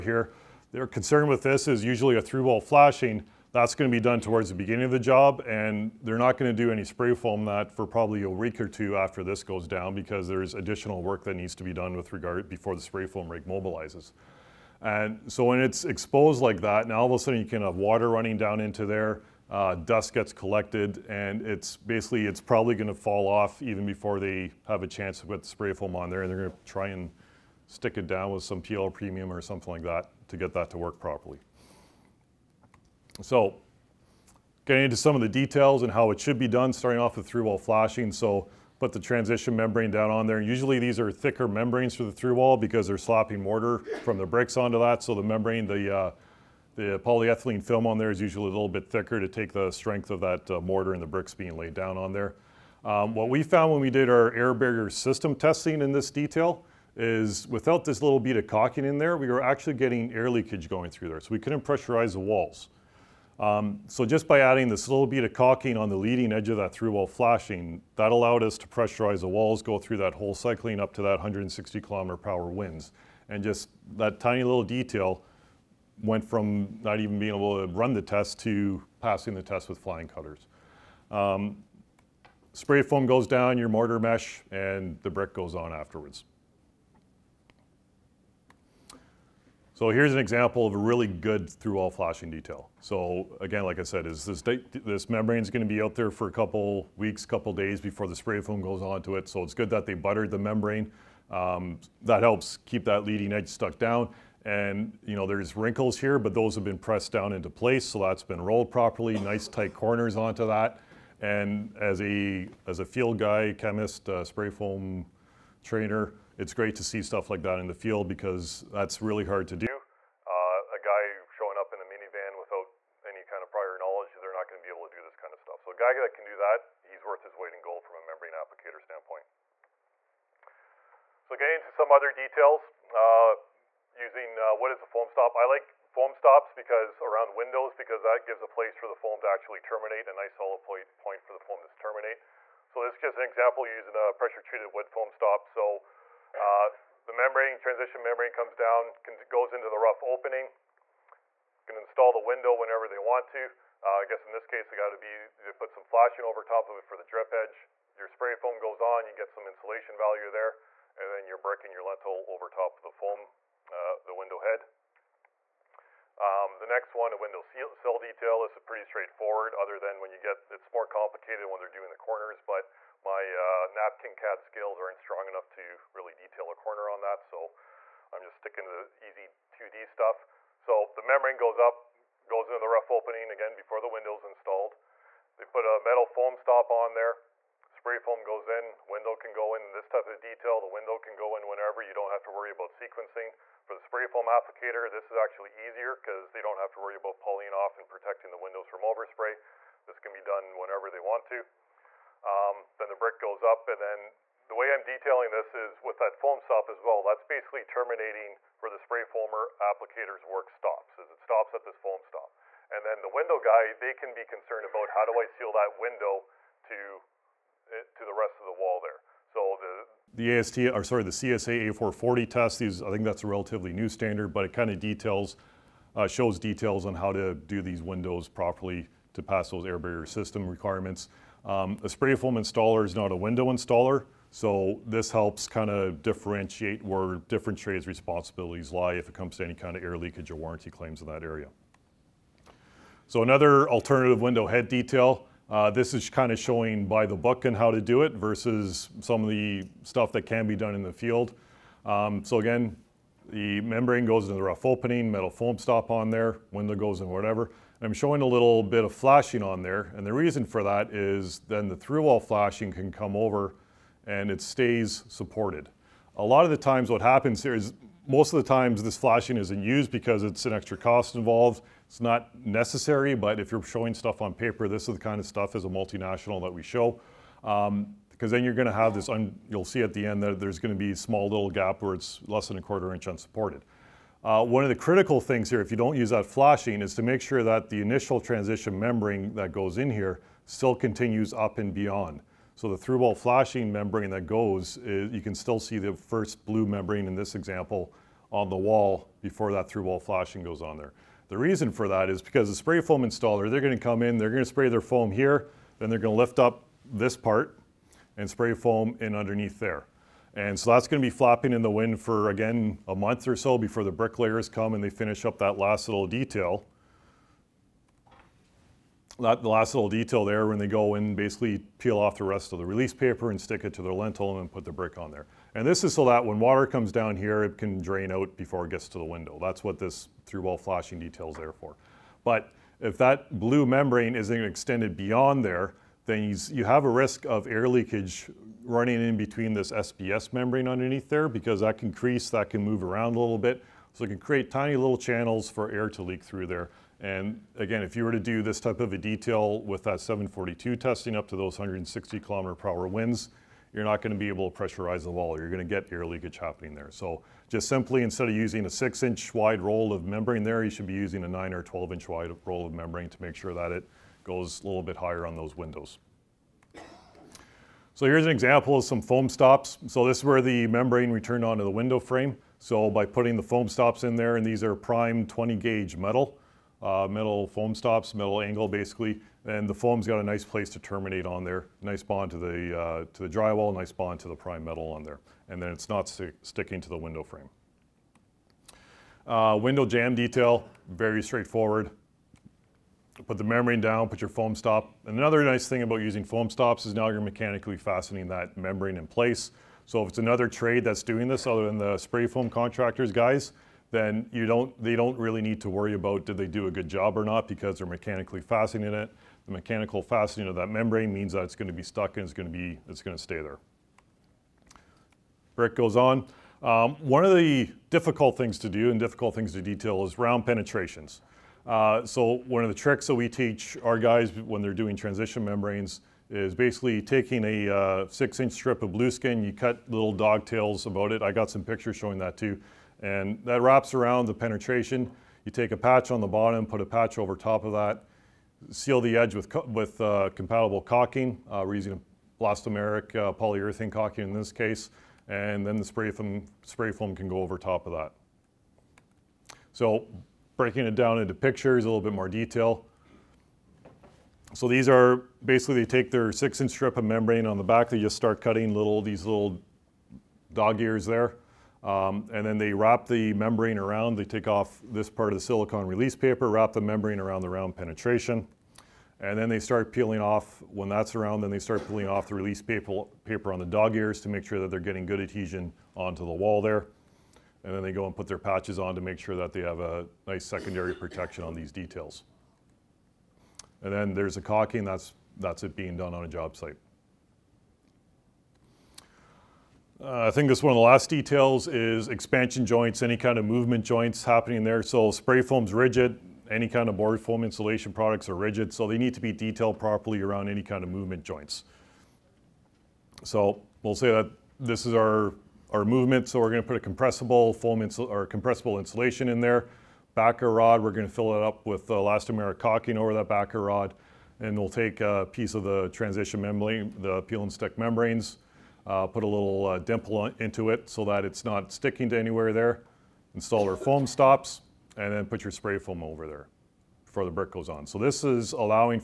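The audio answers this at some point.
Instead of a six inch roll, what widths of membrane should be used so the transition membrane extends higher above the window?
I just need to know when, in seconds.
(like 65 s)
361 s.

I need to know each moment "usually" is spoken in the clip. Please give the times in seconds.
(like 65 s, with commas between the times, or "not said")
1 s, 40 s, 48 s.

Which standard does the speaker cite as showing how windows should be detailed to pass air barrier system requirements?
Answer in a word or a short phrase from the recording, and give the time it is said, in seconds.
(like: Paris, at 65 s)
CSA A440, at 221 s.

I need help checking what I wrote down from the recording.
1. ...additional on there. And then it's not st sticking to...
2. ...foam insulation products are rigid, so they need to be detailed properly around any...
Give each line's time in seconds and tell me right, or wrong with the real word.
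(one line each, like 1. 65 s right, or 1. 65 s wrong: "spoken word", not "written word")
1. 384 s wrong: "metal", not "additional"
2. 497 s right.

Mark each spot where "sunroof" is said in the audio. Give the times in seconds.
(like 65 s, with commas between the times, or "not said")
not said.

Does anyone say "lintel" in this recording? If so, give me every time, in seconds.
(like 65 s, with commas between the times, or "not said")
161 s, 323 s.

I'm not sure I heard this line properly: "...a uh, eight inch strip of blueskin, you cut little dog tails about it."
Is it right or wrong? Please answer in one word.
wrong.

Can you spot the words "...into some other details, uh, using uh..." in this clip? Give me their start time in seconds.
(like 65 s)
131 s.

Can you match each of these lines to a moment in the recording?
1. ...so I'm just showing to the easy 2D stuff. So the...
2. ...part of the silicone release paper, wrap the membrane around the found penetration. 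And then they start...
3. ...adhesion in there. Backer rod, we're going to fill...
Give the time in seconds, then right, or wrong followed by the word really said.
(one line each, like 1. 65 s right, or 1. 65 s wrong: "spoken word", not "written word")
1. 177 s wrong: "sticking", not "showing"
2. 465 s wrong: "round", not "found"
3. 508 s wrong: "insulation", not "adhesion".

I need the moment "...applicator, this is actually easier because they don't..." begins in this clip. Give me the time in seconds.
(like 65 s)
194 s.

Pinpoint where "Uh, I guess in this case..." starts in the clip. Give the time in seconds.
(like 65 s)
153 s.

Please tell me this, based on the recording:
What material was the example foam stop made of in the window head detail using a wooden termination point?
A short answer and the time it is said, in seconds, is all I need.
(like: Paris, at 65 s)
pressure treated wood, at 144 s.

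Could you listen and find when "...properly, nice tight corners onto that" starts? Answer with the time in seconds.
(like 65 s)
108 s.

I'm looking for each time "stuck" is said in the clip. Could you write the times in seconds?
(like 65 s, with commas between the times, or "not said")
103 s, 411 s.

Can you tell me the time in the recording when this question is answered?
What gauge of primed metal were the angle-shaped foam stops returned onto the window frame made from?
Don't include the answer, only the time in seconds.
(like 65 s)
375 s.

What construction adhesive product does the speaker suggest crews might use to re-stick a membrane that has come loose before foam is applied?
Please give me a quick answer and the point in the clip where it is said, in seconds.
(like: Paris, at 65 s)
PL premium, at 28 s.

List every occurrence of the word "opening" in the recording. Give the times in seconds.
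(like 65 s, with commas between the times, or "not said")
150 s, 182 s, 254 s.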